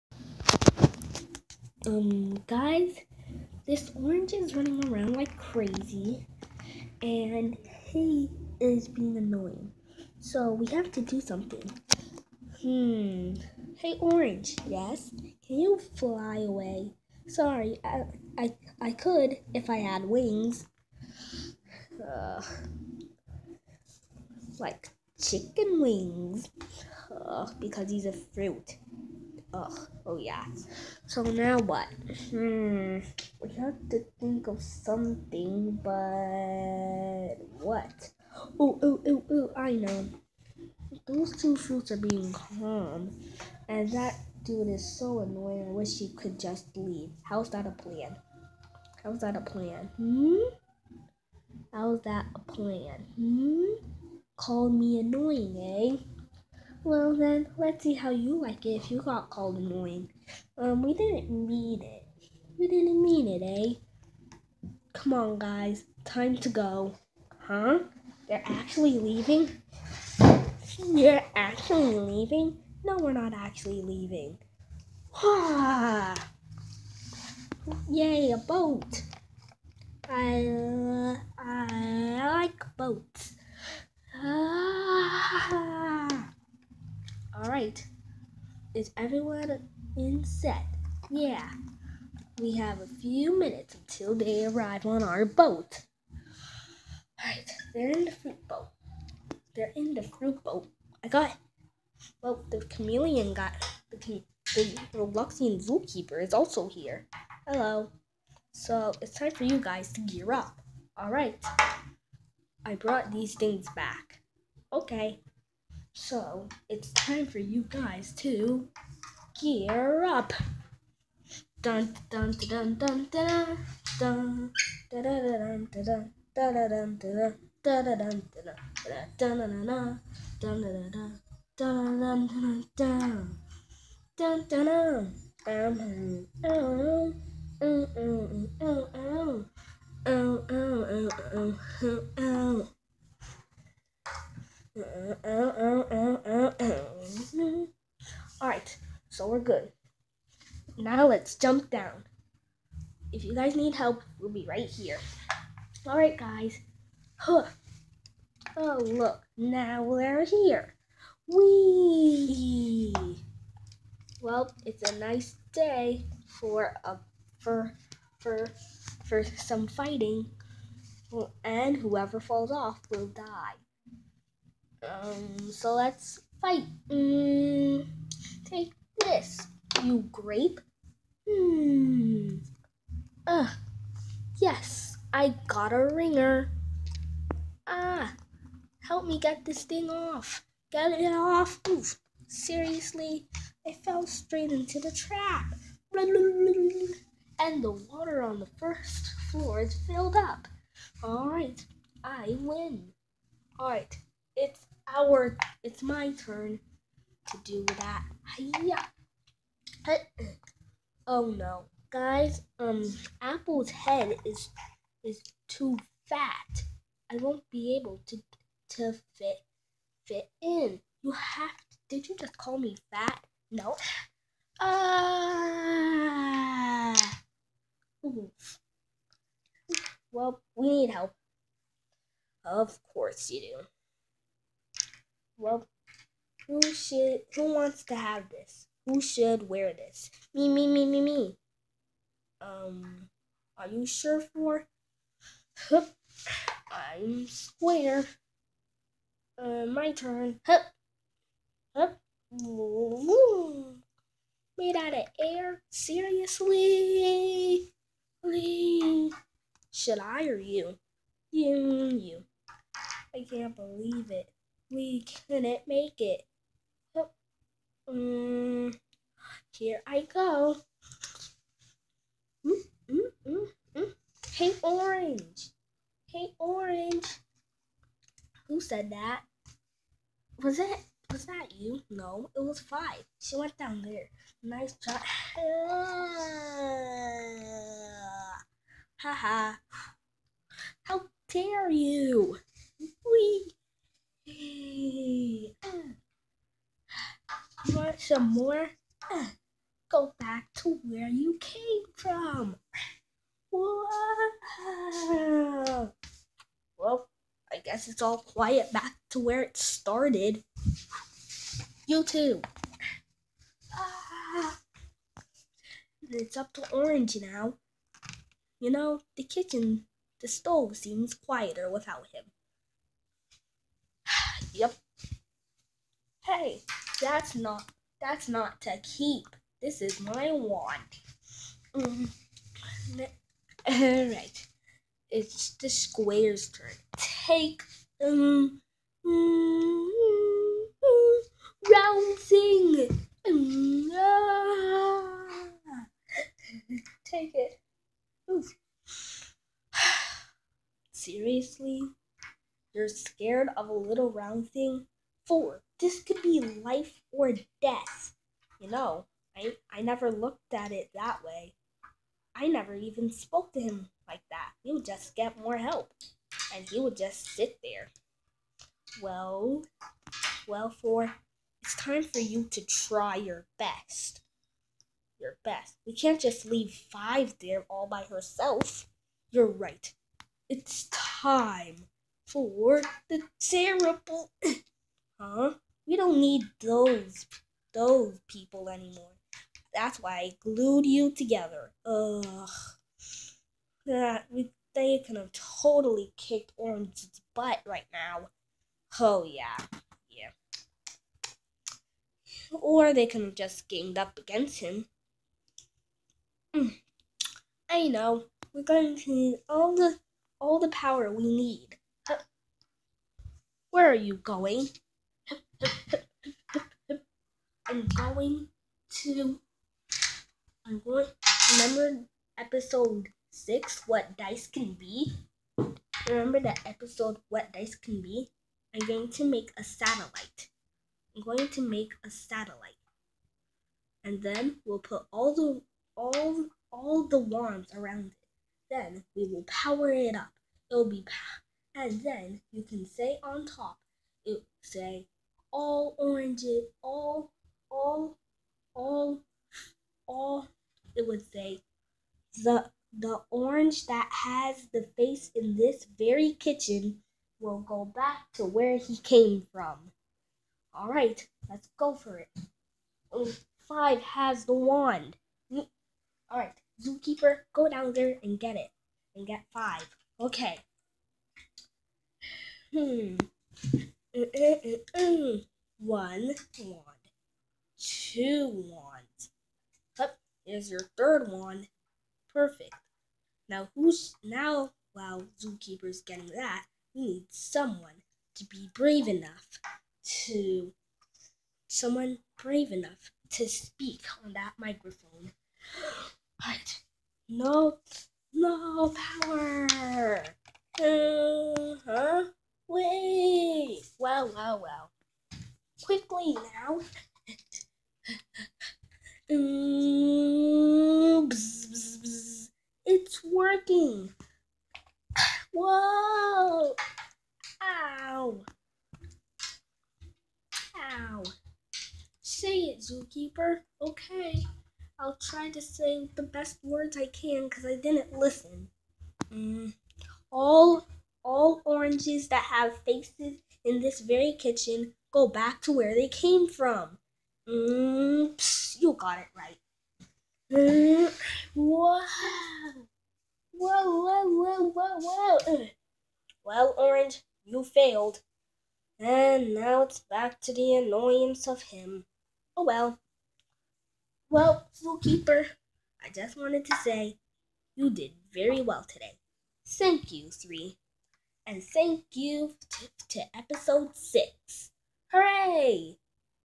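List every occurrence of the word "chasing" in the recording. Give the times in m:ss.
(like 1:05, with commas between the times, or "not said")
not said.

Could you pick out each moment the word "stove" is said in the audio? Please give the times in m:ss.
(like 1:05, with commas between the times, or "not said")
5:20.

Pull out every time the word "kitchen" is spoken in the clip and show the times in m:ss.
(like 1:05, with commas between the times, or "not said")
5:19, 7:36, 8:54.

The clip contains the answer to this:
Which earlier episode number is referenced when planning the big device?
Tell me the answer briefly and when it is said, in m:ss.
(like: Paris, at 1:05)
6, at 7:02.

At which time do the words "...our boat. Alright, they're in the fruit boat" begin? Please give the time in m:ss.
1:35.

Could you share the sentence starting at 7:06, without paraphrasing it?
Remember that episode What Dice Can Be?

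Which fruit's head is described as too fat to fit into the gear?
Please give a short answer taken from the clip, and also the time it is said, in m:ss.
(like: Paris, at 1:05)
Apple, at 3:33.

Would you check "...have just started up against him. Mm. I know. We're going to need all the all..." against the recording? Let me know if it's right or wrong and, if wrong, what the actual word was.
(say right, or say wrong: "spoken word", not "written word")
wrong: "ganged", not "started".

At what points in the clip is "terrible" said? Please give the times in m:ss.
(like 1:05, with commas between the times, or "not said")
6:23.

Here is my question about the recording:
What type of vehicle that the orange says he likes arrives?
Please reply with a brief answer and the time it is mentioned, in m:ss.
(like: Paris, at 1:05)
A boat, at 1:18.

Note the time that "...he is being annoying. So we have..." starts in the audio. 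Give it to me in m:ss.
0:07.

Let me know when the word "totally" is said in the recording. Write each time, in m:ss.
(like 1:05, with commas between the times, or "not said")
6:35.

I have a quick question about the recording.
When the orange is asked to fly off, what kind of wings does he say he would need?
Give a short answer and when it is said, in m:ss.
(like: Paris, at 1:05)
Chicken wings, at 0:25.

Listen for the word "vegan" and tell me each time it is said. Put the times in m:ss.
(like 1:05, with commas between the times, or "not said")
not said.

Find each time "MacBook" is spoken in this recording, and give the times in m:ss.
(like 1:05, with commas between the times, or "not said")
not said.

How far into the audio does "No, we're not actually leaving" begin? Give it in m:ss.
1:12.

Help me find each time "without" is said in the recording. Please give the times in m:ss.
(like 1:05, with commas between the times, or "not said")
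5:21.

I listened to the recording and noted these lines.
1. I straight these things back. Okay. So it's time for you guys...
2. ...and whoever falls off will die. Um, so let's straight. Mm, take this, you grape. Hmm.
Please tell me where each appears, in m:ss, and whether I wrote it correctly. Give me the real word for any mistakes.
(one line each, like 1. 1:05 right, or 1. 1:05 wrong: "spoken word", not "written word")
1. 1:52 wrong: "brought", not "straight"
2. 2:51 wrong: "fight", not "straight".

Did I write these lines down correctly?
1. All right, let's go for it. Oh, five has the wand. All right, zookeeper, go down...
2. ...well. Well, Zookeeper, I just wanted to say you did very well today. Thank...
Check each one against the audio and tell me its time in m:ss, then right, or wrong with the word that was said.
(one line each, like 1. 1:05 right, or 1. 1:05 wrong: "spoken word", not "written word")
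1. 7:40 right
2. 9:12 right.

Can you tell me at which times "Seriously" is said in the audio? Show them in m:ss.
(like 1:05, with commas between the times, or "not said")
3:12, 4:15, 5:50.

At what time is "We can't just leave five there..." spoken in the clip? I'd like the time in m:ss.
6:15.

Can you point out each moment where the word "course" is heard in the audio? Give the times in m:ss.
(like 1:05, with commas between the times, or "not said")
3:52.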